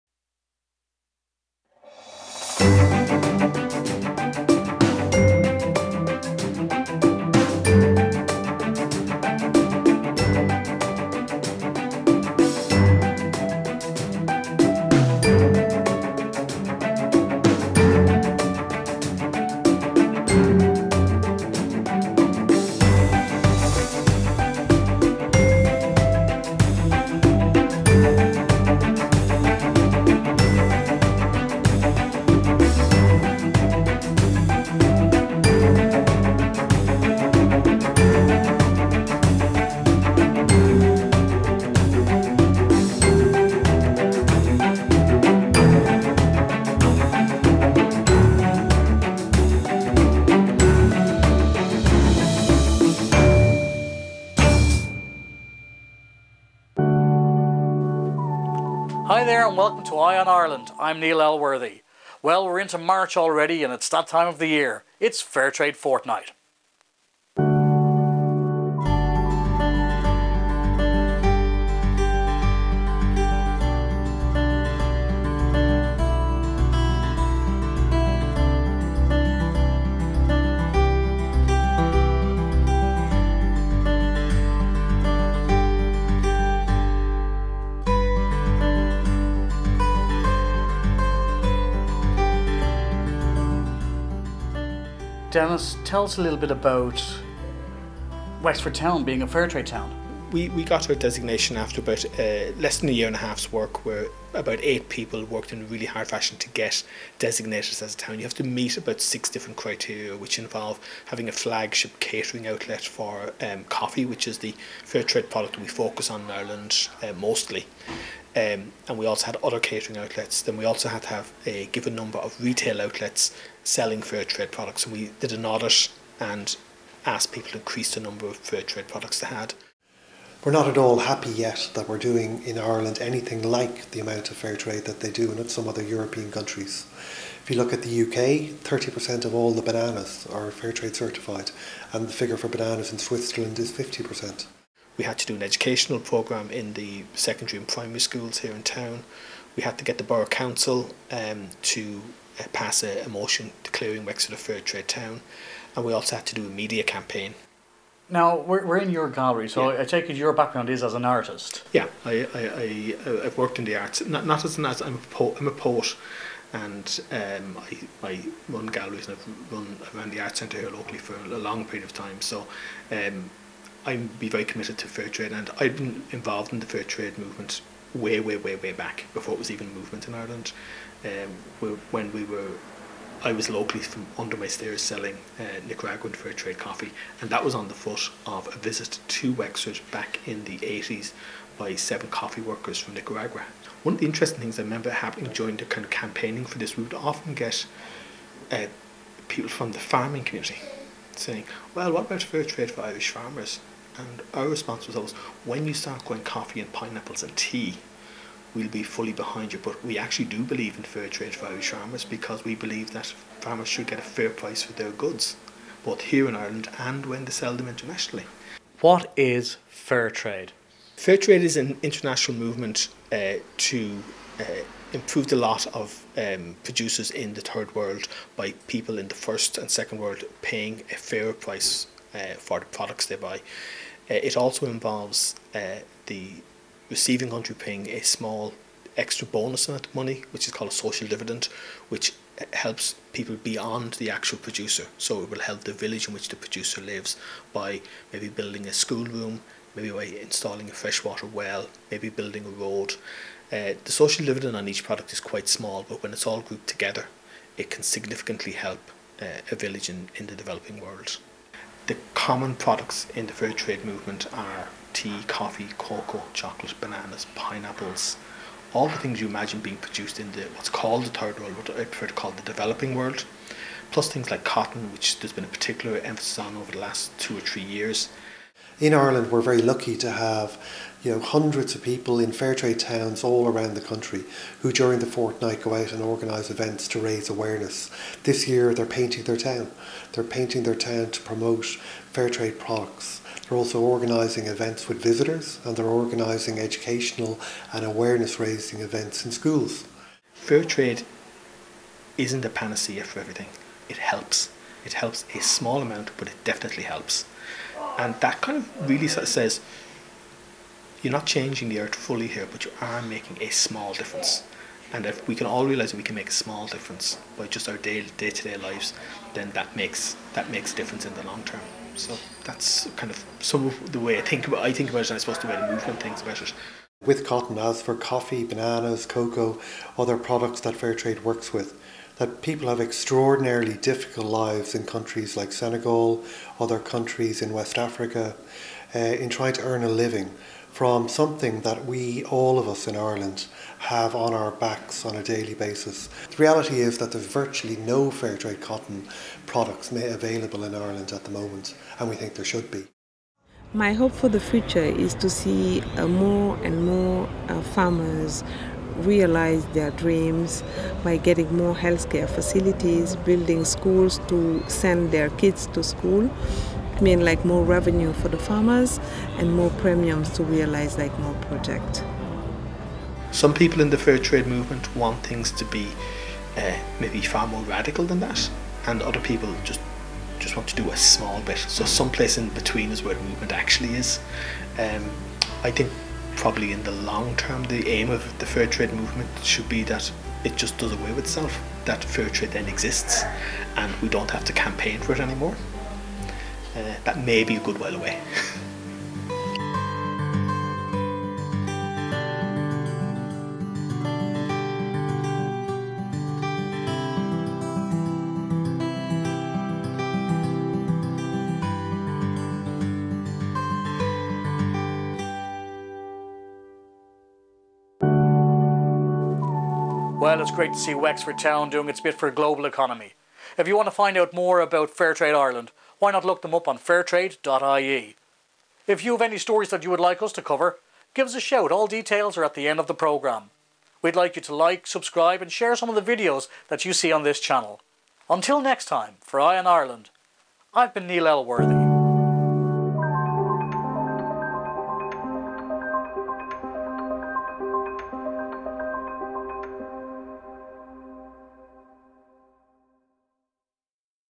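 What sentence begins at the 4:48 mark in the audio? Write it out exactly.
This year they're painting their town.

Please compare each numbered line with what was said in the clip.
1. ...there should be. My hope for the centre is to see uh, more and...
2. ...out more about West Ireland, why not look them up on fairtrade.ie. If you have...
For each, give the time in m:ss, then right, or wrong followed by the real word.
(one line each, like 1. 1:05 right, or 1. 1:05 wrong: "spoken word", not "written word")
1. 5:52 wrong: "future", not "centre"
2. 7:04 wrong: "Fairtrade", not "West".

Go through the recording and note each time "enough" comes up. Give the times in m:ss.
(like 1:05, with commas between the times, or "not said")
not said.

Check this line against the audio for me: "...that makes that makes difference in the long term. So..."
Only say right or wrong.
right.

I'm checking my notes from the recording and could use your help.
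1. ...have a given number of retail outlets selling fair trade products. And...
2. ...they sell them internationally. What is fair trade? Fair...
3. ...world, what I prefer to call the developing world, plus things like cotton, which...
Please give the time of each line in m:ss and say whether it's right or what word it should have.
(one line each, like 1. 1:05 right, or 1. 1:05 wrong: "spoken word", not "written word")
1. 2:01 right
2. 3:37 right
3. 4:31 right.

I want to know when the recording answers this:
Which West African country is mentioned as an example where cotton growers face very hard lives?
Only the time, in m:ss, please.
5:35.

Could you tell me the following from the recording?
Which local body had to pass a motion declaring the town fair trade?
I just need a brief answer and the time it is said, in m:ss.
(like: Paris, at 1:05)
Borough Council, at 2:30.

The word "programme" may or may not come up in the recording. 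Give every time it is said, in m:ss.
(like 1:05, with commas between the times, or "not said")
2:25, 7:12.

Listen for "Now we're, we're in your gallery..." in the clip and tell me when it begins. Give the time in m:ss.
2:38.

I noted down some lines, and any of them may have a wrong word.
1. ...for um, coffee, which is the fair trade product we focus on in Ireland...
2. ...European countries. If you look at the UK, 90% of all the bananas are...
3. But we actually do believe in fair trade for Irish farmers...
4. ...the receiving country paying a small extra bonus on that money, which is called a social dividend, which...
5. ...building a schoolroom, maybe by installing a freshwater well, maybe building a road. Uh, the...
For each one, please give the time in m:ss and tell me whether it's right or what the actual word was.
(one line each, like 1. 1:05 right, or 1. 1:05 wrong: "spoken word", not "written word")
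1. 1:52 right
2. 2:15 wrong: "30", not "90"
3. 3:29 right
4. 3:56 right
5. 4:08 right.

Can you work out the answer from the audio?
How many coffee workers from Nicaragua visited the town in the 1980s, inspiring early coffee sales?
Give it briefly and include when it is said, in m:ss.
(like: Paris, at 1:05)
7, at 3:11.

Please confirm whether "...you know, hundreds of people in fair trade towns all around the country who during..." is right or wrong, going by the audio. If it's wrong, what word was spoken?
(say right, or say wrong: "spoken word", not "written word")
right.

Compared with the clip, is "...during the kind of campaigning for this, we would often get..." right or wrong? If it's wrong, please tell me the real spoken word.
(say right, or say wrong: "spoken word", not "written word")
right.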